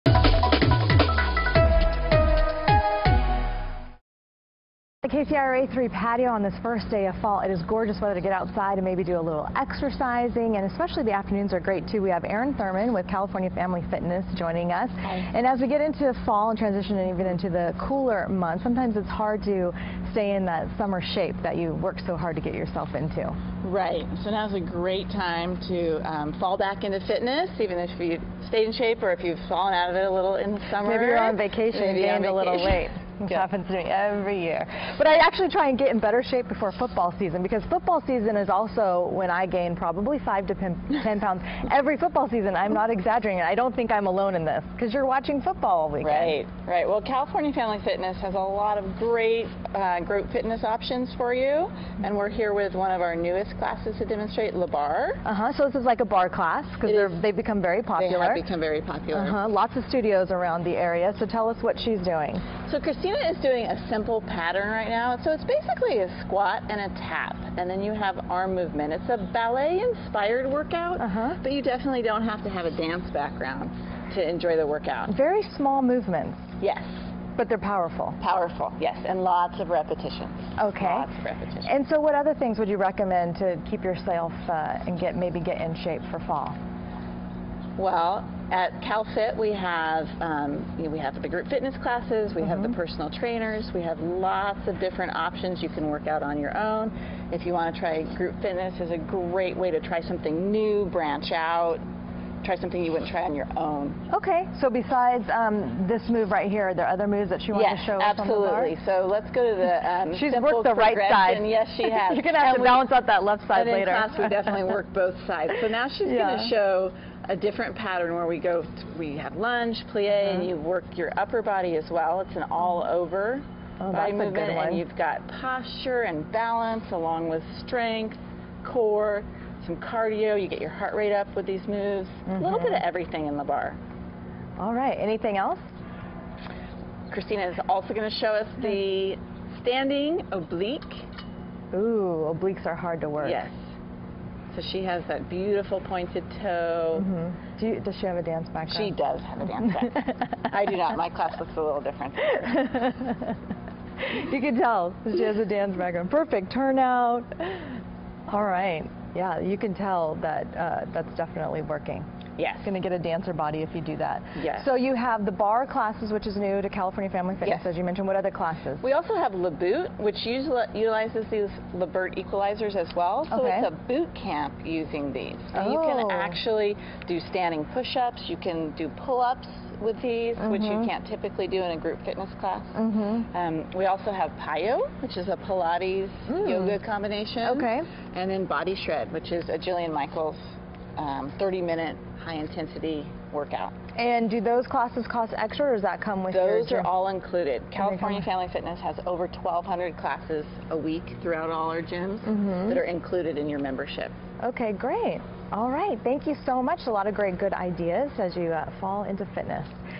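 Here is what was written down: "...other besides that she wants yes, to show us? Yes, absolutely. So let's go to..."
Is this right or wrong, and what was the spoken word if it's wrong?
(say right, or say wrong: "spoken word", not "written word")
wrong: "moves", not "besides".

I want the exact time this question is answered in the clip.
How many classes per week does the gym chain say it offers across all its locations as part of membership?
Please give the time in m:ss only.
3:19.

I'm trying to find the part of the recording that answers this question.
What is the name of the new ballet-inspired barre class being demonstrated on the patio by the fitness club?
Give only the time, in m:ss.
0:54.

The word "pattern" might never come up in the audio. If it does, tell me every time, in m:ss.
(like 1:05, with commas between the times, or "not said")
1:04, 1:57.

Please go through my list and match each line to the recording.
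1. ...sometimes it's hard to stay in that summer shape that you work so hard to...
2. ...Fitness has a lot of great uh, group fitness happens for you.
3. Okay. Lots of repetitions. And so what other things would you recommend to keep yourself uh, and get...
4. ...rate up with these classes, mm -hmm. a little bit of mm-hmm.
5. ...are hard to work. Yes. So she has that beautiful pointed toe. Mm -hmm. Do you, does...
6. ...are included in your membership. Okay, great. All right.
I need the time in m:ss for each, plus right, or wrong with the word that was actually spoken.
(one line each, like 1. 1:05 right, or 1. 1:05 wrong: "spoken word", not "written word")
1. 0:18 right
2. 0:47 wrong: "options", not "happens"
3. 1:20 right
4. 2:10 wrong: "moves", not "classes"
5. 2:22 right
6. 3:22 right.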